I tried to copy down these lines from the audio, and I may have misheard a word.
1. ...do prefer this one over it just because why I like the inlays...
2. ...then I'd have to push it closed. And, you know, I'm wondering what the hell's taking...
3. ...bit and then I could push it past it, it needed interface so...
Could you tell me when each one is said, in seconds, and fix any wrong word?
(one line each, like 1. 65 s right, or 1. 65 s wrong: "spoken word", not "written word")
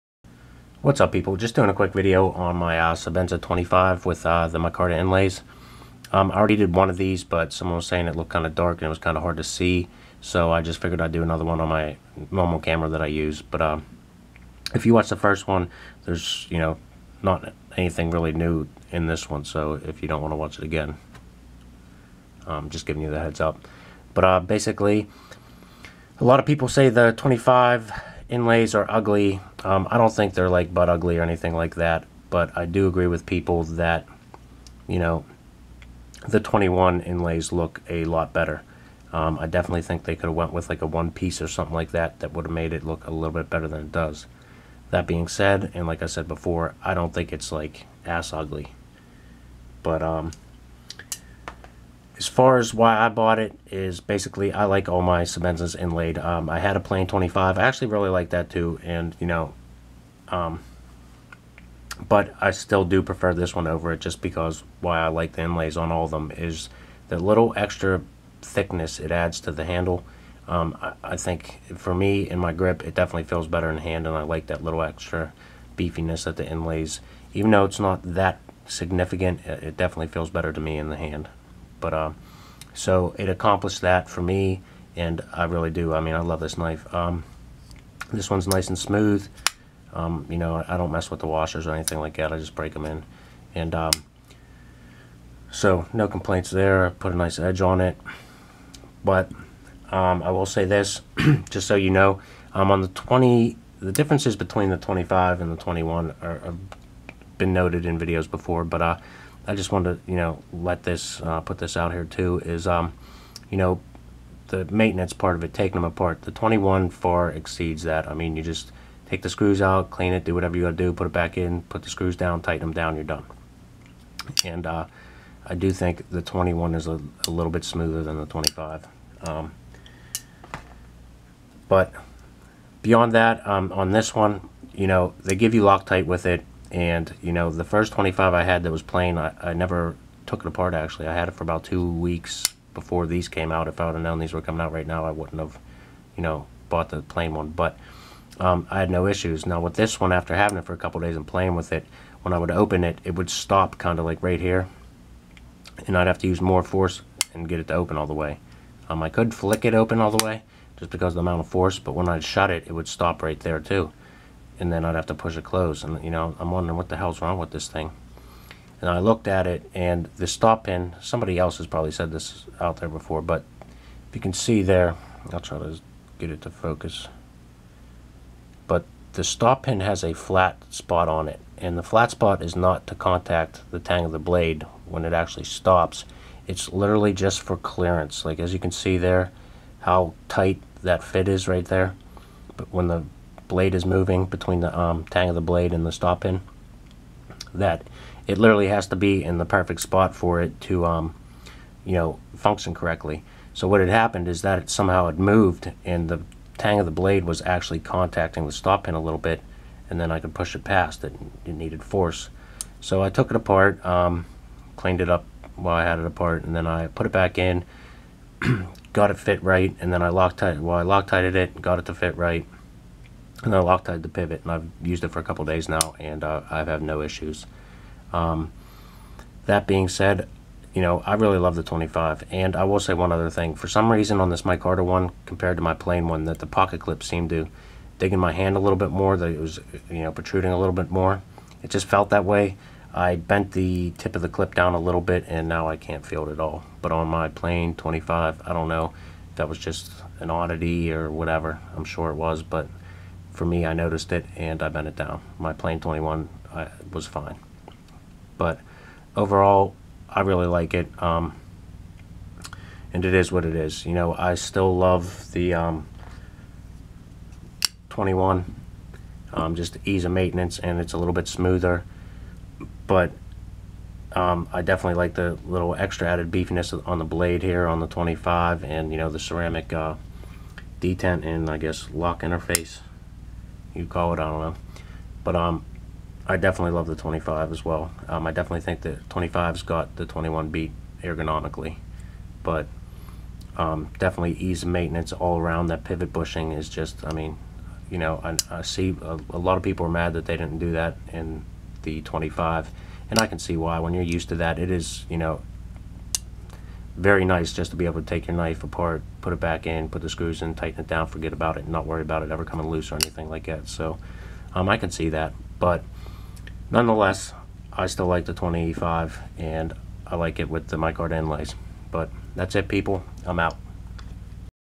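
1. 62 s right
2. 164 s wrong: "wrong", not "taking"
3. 209 s wrong: "force", not "interface".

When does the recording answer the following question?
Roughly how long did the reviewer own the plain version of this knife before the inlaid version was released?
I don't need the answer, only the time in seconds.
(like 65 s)
141 s.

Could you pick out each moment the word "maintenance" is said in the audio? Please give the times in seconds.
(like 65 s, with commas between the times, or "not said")
114 s, 270 s, 294 s.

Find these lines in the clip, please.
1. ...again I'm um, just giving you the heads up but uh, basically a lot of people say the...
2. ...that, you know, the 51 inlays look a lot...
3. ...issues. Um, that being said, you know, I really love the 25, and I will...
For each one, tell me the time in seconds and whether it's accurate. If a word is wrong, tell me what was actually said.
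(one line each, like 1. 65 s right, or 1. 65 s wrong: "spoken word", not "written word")
1. 20 s right
2. 33 s wrong: "21", not "51"
3. 227 s right.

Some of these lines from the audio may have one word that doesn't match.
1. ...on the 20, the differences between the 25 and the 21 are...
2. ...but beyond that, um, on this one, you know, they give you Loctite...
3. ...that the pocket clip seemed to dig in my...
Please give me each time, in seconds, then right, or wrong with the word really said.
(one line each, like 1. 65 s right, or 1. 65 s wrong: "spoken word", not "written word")
1. 102 s right
2. 131 s right
3. 236 s right.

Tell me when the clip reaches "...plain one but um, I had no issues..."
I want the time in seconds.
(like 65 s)
147 s.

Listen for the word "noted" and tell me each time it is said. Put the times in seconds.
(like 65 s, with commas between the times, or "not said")
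107 s.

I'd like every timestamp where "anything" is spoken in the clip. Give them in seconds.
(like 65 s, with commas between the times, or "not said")
17 s, 31 s, 91 s, 312 s.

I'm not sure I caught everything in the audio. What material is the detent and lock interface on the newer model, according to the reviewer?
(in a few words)
ceramic.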